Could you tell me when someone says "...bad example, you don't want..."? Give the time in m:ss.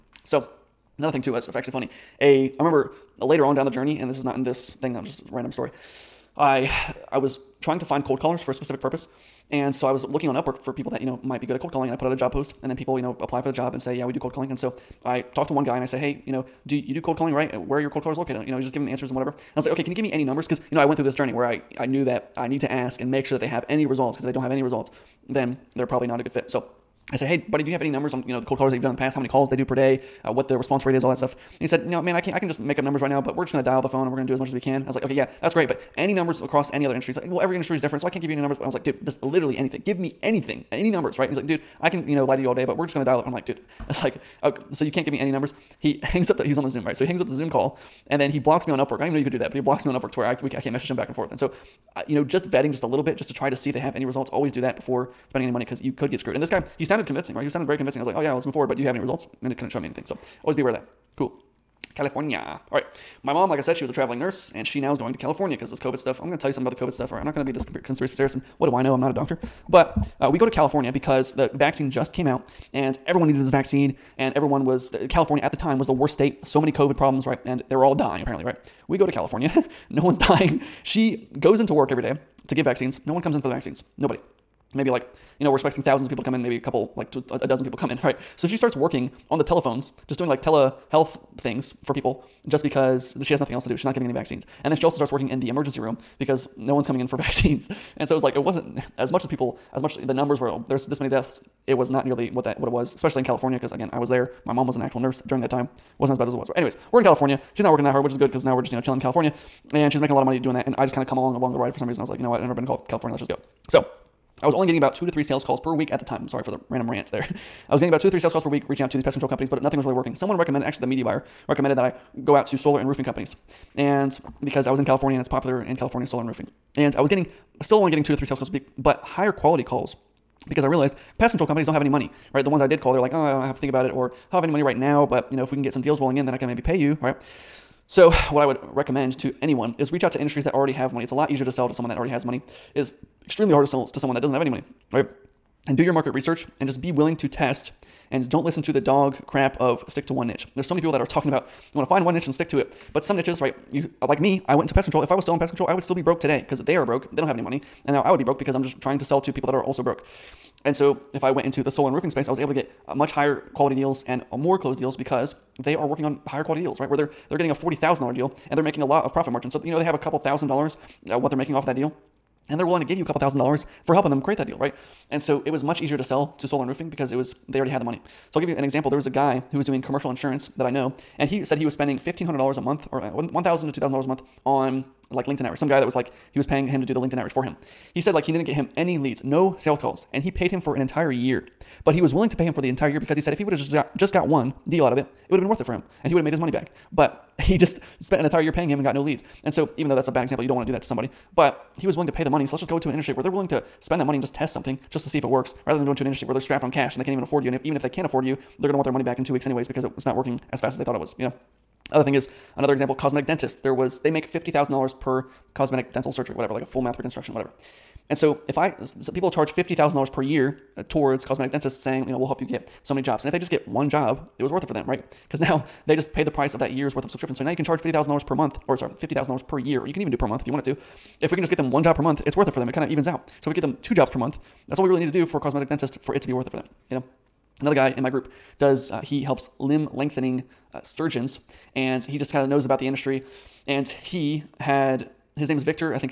3:20.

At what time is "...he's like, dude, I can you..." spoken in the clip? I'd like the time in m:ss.
0:41.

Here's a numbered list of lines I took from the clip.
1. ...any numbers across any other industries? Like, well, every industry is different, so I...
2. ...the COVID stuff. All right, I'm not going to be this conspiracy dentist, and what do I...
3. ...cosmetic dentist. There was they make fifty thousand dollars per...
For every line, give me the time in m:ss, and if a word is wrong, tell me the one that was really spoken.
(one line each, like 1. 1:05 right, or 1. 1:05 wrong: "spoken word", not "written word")
1. 0:35 right
2. 1:06 wrong: "theorist", not "dentist"
3. 3:32 right.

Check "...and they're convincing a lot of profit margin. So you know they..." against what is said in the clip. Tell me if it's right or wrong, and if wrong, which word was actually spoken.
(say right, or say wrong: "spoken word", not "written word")
wrong: "making", not "convincing".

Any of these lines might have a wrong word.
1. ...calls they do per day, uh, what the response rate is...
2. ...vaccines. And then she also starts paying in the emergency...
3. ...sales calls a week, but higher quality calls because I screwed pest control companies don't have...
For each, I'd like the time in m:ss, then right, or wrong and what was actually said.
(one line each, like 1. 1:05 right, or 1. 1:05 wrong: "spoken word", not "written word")
1. 0:29 right
2. 1:34 wrong: "working", not "paying"
3. 2:08 wrong: "realized", not "screwed".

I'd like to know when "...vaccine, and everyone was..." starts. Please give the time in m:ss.
1:13.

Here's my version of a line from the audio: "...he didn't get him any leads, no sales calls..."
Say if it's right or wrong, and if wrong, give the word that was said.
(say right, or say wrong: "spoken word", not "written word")
right.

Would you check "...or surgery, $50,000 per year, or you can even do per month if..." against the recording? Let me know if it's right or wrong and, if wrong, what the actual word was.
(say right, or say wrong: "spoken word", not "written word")
wrong: "sorry", not "surgery".